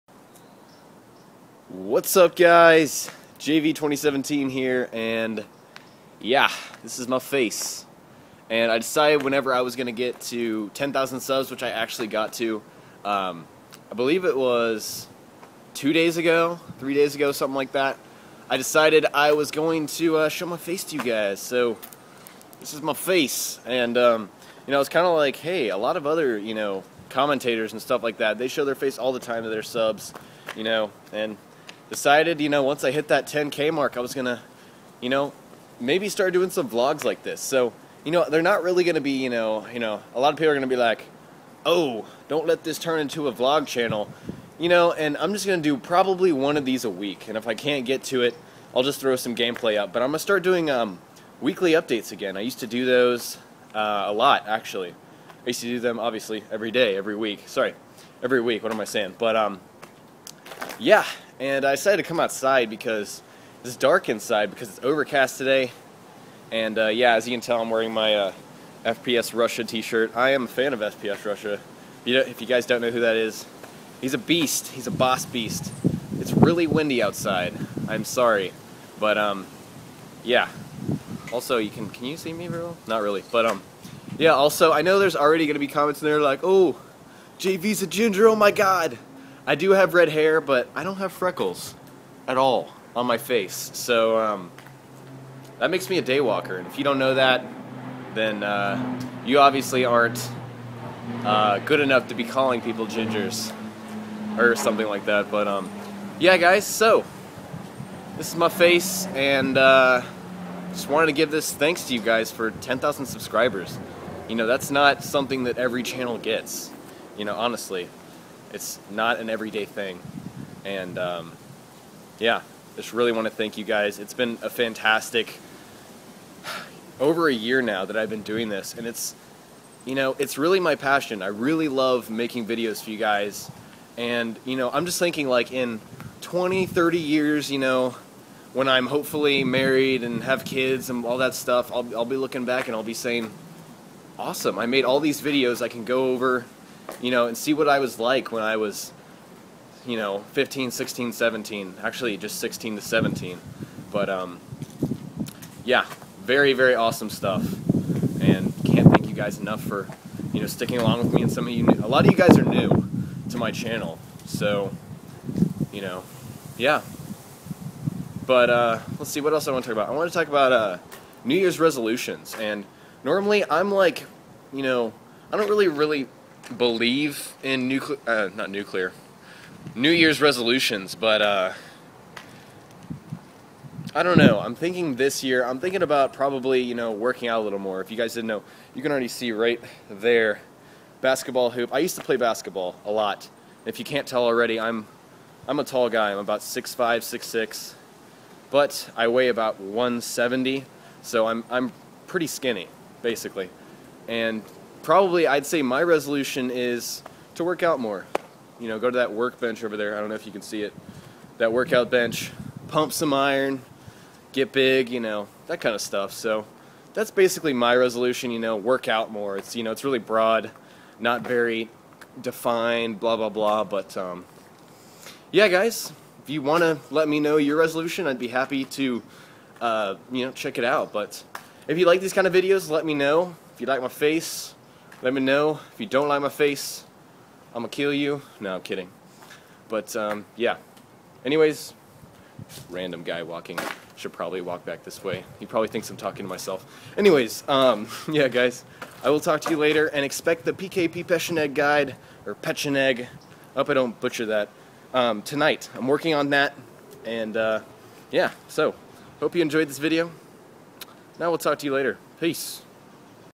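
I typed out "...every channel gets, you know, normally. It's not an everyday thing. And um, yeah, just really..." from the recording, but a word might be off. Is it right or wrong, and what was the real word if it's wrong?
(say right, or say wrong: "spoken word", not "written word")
wrong: "honestly", not "normally".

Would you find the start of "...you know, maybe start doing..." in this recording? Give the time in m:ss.
0:35.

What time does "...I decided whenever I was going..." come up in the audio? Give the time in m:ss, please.
0:08.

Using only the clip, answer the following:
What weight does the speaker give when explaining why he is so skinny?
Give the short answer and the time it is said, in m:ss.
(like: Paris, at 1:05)
170, at 3:19.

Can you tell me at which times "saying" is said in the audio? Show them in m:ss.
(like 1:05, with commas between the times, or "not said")
0:58, 2:22.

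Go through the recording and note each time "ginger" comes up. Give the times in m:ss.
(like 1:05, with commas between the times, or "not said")
1:27, 1:42.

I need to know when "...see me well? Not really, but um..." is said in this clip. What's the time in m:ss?
1:22.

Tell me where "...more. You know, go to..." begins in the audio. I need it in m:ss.
3:27.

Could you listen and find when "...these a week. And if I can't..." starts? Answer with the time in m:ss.
0:46.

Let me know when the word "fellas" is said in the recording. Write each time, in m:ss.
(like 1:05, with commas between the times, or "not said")
not said.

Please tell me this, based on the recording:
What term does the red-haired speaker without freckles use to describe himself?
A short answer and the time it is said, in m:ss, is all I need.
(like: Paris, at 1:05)
daywalker, at 1:36.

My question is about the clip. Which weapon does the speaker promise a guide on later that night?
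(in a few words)
PKP Pecheneg.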